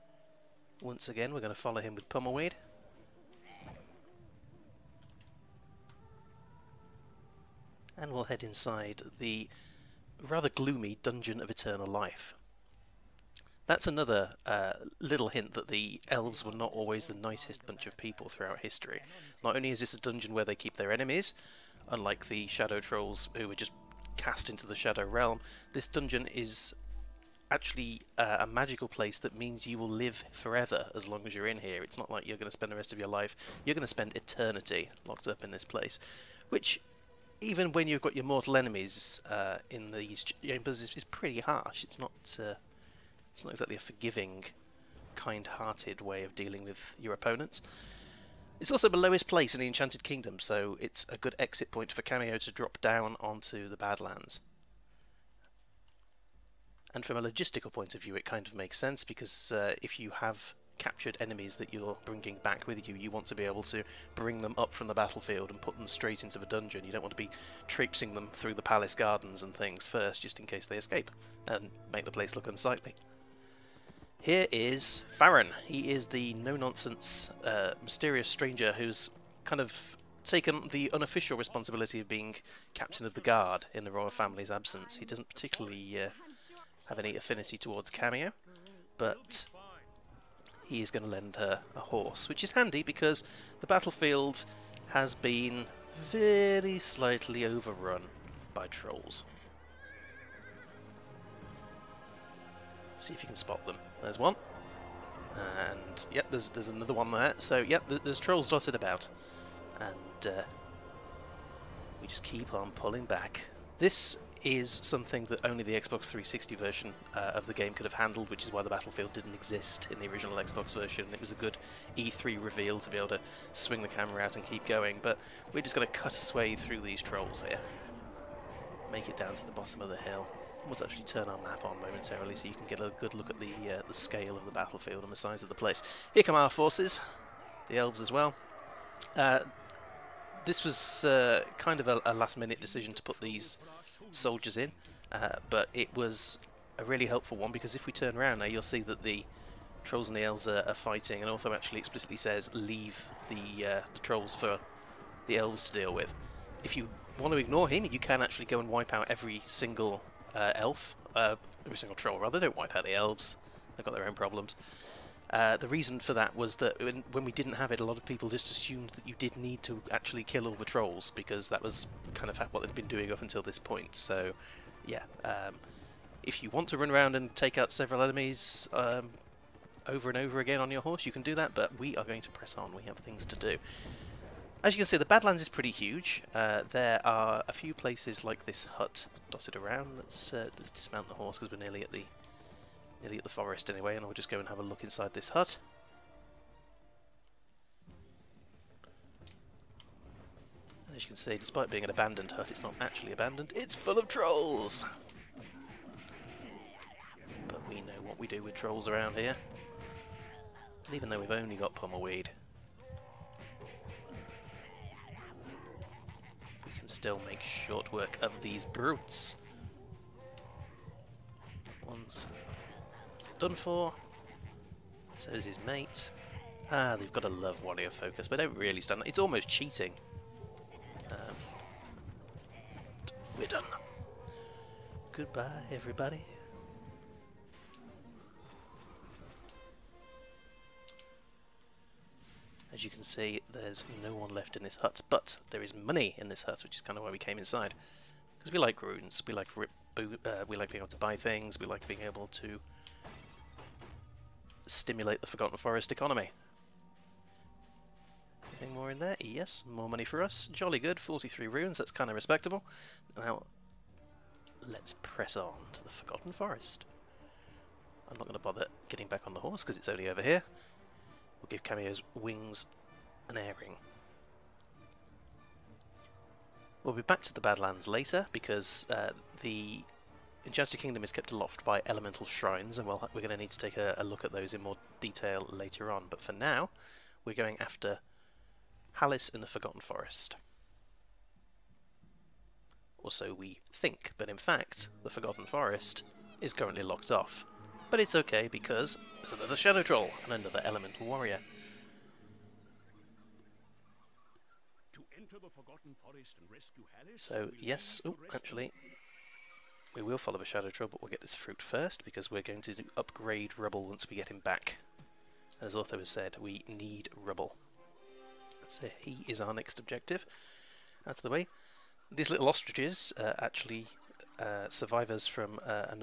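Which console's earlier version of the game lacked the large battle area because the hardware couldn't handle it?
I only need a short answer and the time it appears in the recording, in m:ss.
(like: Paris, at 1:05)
original Xbox, at 2:00.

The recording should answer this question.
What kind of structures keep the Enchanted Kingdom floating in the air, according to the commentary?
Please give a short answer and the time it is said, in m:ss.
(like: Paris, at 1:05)
elemental shrines, at 4:41.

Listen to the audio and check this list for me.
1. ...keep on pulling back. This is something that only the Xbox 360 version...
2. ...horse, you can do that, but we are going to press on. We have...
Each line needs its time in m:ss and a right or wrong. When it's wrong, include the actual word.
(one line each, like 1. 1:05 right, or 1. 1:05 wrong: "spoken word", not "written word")
1. 1:52 right
2. 3:00 right.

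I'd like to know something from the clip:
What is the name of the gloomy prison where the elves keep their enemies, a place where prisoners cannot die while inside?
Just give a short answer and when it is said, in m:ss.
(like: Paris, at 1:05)
Dungeon of Eternal Life, at 0:11.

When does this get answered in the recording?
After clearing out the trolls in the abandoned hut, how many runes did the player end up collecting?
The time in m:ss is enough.
4:21.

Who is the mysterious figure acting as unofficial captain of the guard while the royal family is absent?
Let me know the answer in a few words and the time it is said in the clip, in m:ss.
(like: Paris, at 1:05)
Farron, at 1:15.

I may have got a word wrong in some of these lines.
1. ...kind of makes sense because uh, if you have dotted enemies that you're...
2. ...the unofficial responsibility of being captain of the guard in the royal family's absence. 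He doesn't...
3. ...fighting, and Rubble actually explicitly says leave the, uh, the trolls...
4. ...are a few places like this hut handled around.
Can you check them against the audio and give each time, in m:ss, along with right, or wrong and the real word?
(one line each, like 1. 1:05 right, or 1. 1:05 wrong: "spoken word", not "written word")
1. 0:58 wrong: "captured", not "dotted"
2. 1:20 right
3. 2:30 wrong: "Ortho", not "Rubble"
4. 3:07 wrong: "dotted", not "handled".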